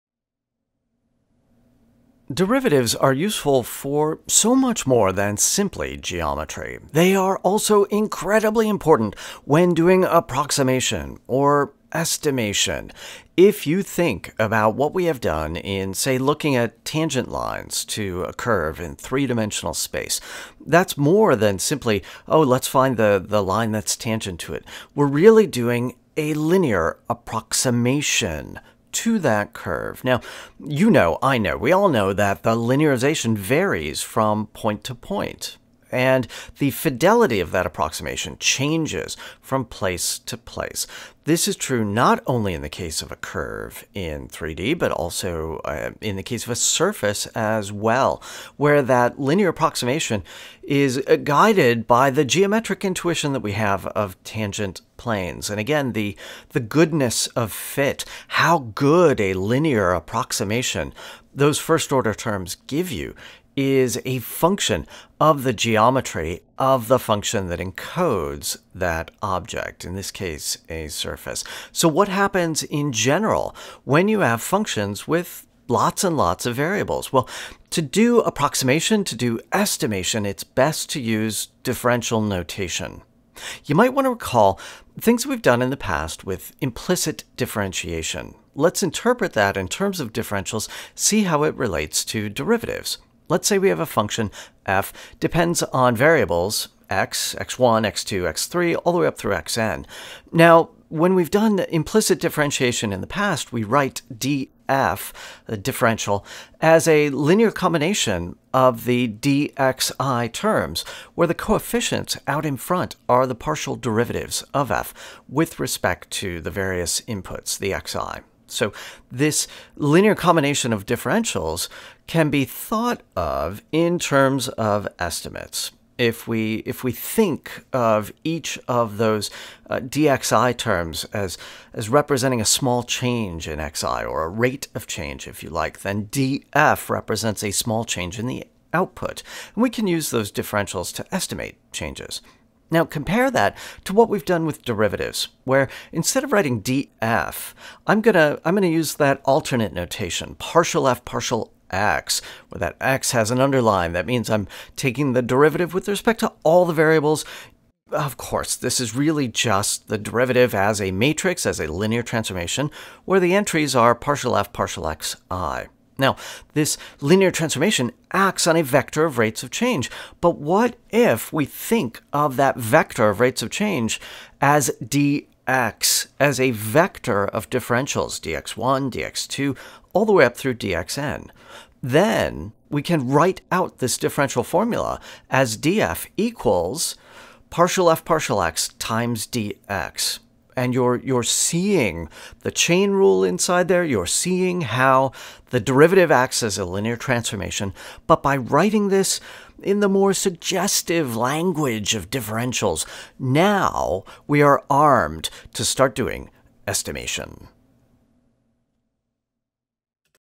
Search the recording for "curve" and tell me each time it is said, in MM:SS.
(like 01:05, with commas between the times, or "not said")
00:18, 00:29, 00:43.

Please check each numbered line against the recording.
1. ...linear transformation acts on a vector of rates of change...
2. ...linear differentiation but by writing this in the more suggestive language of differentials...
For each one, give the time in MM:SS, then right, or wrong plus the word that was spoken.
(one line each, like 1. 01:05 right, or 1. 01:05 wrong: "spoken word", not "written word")
1. 02:47 right
2. 03:16 wrong: "transformation", not "differentiation".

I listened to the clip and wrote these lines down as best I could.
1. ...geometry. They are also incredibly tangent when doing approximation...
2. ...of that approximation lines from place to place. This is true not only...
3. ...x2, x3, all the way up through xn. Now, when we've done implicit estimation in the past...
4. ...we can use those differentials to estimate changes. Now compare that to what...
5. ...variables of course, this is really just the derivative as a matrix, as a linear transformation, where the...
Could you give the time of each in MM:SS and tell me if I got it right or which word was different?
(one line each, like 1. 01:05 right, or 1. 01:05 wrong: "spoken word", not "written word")
1. 00:05 wrong: "important", not "tangent"
2. 00:37 wrong: "changes", not "lines"
3. 01:37 wrong: "differentiation", not "estimation"
4. 02:19 right
5. 02:36 right.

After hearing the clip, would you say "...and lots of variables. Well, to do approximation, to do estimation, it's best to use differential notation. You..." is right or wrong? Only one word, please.
right.